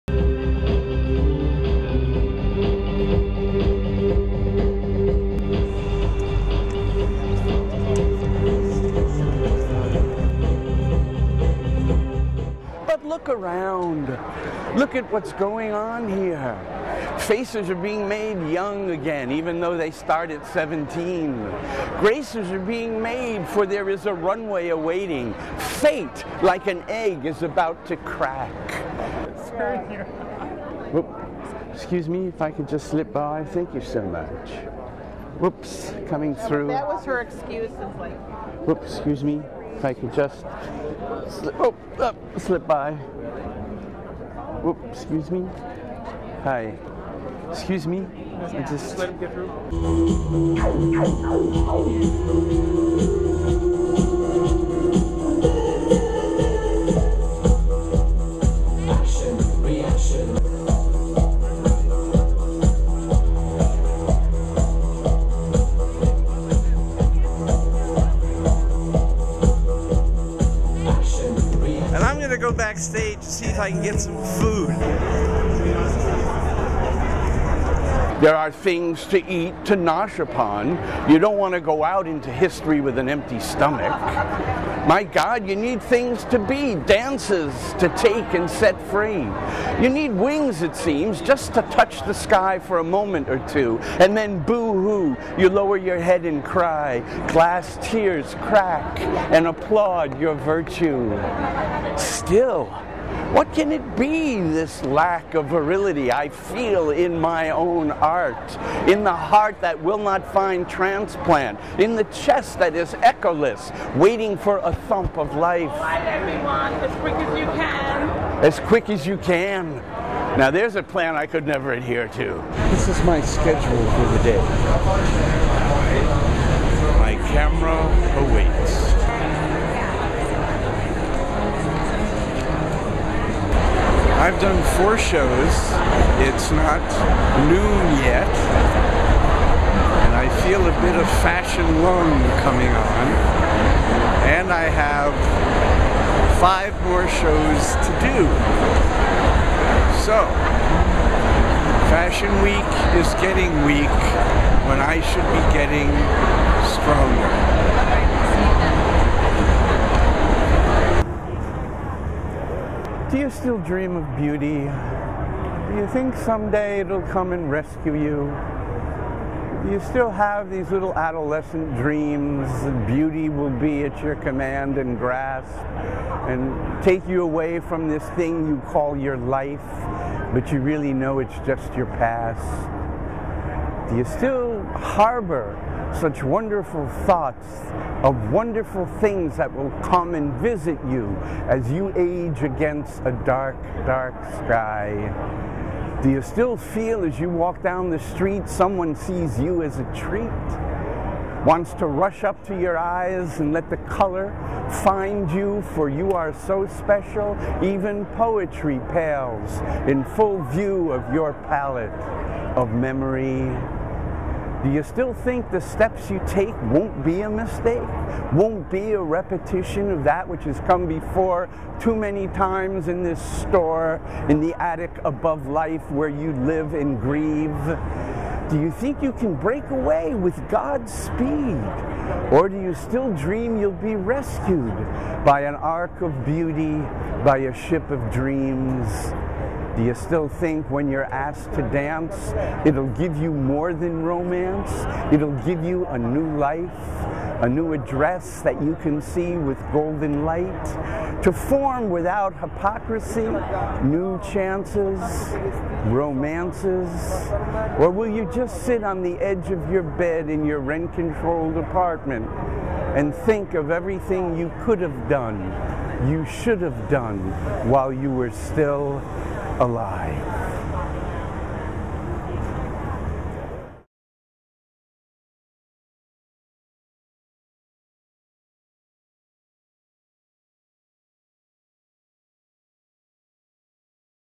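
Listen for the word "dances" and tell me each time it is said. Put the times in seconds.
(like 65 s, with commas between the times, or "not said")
86 s, 241 s.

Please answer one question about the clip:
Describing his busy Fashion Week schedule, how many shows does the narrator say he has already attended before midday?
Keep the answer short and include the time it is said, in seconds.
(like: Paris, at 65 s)
4, at 134 s.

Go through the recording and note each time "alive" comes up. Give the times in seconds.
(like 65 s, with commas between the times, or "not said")
269 s.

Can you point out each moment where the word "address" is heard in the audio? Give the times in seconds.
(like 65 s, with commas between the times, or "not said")
247 s.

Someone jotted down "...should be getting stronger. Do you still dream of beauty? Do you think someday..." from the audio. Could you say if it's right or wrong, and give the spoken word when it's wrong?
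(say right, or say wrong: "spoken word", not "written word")
right.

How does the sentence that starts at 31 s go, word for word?
Excuse me if I could just slip by.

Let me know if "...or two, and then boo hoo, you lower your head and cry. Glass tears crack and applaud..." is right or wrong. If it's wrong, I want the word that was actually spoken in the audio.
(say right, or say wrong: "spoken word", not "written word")
right.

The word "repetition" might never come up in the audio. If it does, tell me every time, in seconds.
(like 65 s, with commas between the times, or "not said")
219 s.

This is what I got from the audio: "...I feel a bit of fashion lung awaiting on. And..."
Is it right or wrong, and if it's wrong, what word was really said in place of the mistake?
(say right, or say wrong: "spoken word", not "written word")
wrong: "coming", not "awaiting".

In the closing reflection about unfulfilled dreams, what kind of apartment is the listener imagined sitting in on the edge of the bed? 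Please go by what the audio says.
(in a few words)
rent controlled.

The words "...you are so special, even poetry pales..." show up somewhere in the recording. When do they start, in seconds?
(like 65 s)
205 s.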